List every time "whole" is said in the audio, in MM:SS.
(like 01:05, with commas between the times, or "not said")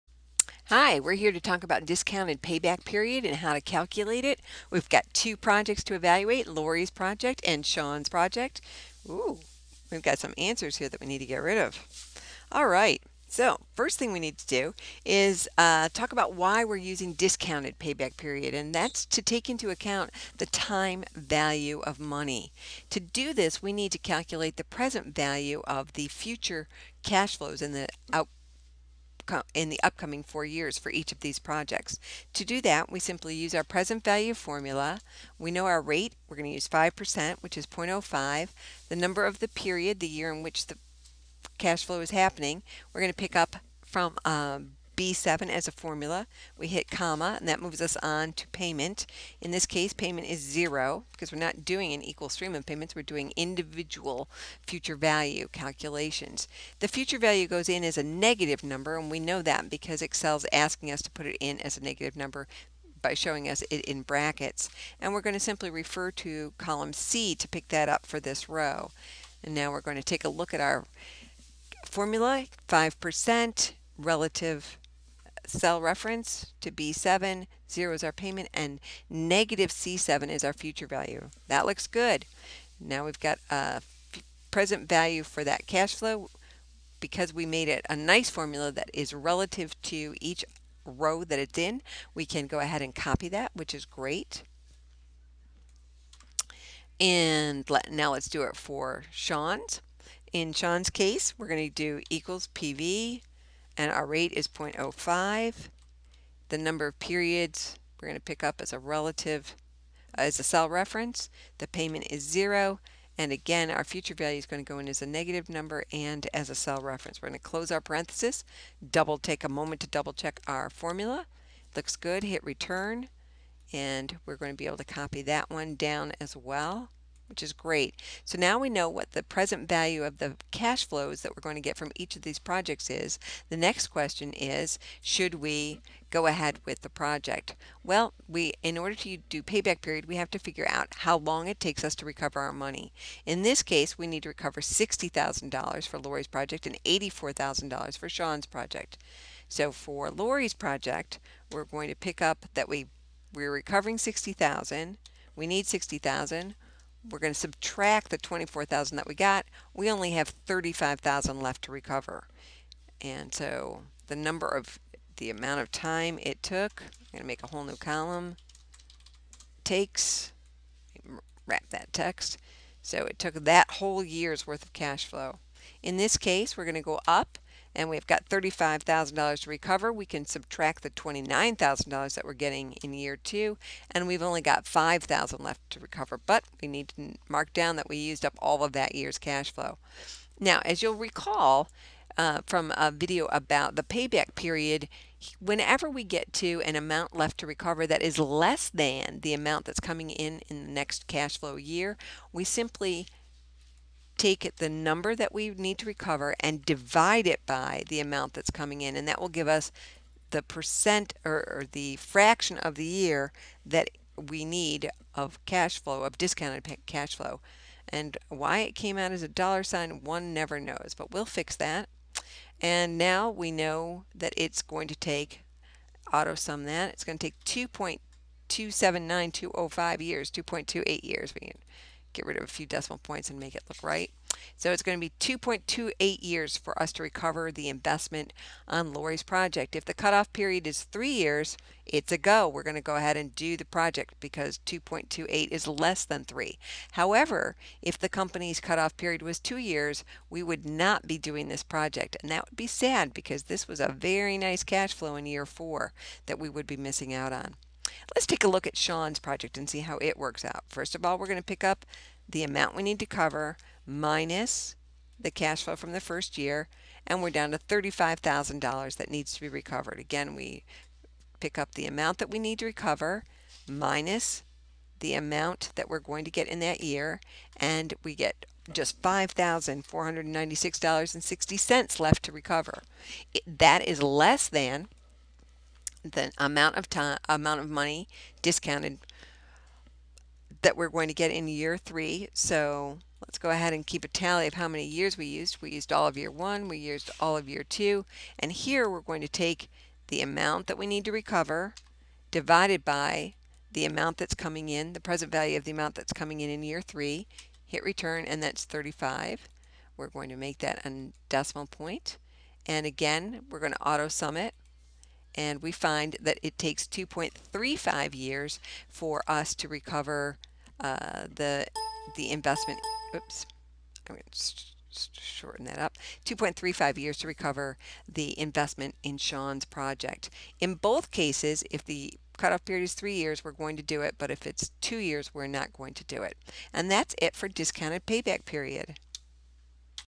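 02:47, 02:53.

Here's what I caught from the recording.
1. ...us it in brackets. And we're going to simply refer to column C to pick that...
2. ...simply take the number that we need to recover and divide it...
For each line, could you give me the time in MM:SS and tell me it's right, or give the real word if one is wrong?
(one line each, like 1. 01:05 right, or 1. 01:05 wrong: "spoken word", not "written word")
1. 01:03 right
2. 03:22 right.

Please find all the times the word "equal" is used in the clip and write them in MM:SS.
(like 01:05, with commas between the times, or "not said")
00:52, 01:42.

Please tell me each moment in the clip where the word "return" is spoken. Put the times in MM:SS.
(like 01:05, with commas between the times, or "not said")
02:02, 05:07.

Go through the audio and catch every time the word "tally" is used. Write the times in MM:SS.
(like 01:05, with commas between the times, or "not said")
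04:54.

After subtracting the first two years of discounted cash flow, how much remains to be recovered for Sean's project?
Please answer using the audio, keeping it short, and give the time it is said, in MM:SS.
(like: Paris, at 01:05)
$5,496.60, at 04:39.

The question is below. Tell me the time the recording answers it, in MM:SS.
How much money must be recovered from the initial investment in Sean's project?
02:26.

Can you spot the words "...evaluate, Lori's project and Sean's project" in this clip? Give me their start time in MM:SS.
00:05.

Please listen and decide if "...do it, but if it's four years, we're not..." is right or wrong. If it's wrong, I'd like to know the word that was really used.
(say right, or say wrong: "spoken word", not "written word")
wrong: "two", not "four".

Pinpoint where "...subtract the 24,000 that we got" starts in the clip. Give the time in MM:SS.
02:37.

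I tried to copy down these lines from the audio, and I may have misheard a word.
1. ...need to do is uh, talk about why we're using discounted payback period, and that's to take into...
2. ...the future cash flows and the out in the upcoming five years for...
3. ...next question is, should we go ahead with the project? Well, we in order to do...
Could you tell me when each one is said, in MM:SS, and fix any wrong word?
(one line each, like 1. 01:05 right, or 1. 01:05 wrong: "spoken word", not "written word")
1. 00:14 right
2. 00:25 wrong: "four", not "five"
3. 02:13 right.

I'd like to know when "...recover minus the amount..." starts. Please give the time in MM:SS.
04:32.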